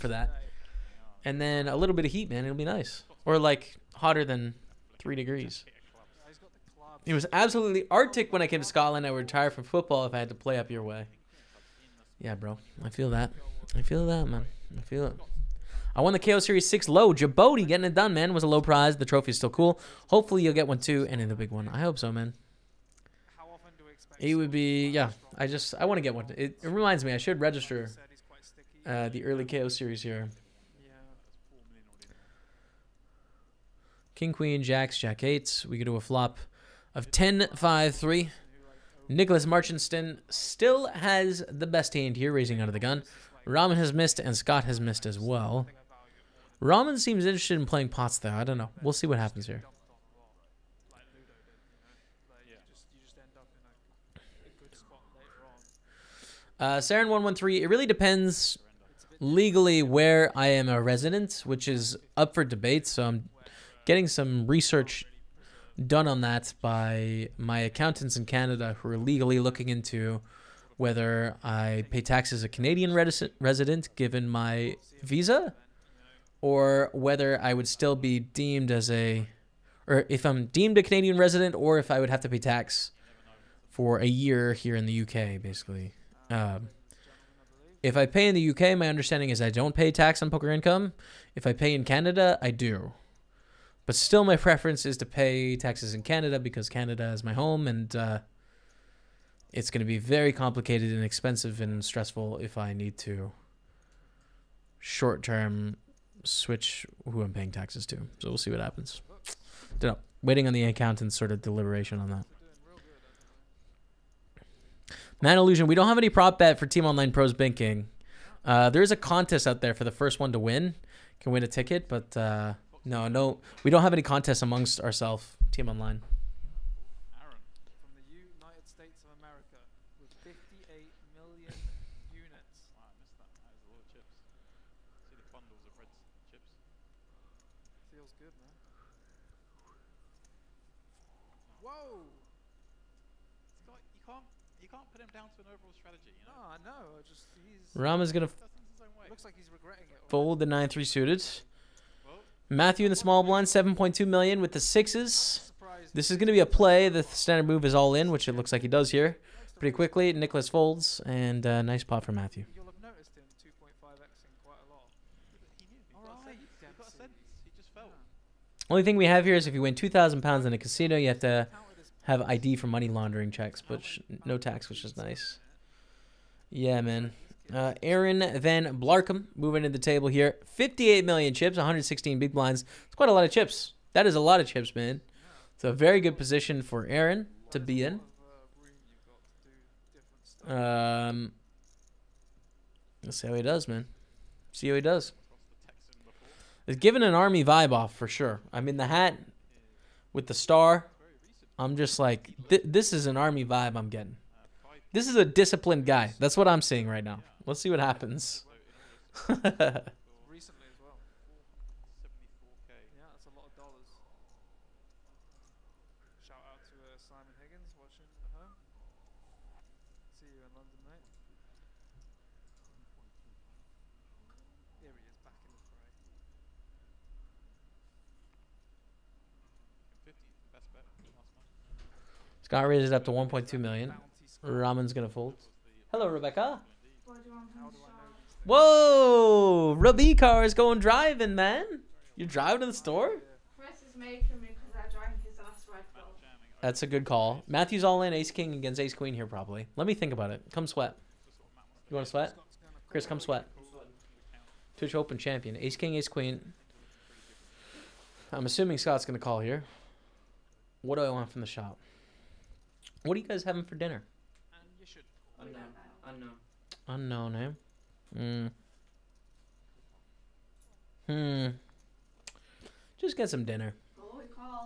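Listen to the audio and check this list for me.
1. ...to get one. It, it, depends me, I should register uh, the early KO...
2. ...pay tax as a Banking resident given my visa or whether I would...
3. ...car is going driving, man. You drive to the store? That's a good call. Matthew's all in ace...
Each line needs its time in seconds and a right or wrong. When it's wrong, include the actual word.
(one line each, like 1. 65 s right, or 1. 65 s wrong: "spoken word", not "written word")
1. 25 s wrong: "reminds", not "depends"
2. 71 s wrong: "Canadian", not "Banking"
3. 240 s right.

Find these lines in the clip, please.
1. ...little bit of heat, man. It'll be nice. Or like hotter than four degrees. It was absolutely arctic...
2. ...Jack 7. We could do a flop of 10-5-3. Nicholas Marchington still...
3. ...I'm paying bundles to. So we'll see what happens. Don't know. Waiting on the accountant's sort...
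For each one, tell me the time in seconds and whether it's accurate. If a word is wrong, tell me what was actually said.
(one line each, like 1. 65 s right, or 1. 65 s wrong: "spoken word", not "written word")
1. 1 s wrong: "three", not "four"
2. 34 s wrong: "8", not "7"
3. 107 s wrong: "taxes", not "bundles".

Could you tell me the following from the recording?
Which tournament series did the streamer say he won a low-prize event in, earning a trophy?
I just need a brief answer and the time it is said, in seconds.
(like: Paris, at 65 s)
KO Series 6, at 16 s.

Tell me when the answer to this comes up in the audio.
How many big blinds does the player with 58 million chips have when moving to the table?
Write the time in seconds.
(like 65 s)
181 s.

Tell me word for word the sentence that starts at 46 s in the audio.
Rahman seems interested in playing pots, though.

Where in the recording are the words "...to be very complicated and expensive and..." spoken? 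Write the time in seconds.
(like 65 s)
99 s.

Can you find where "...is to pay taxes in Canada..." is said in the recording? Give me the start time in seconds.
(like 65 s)
94 s.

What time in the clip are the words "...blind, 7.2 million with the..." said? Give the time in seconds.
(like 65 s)
153 s.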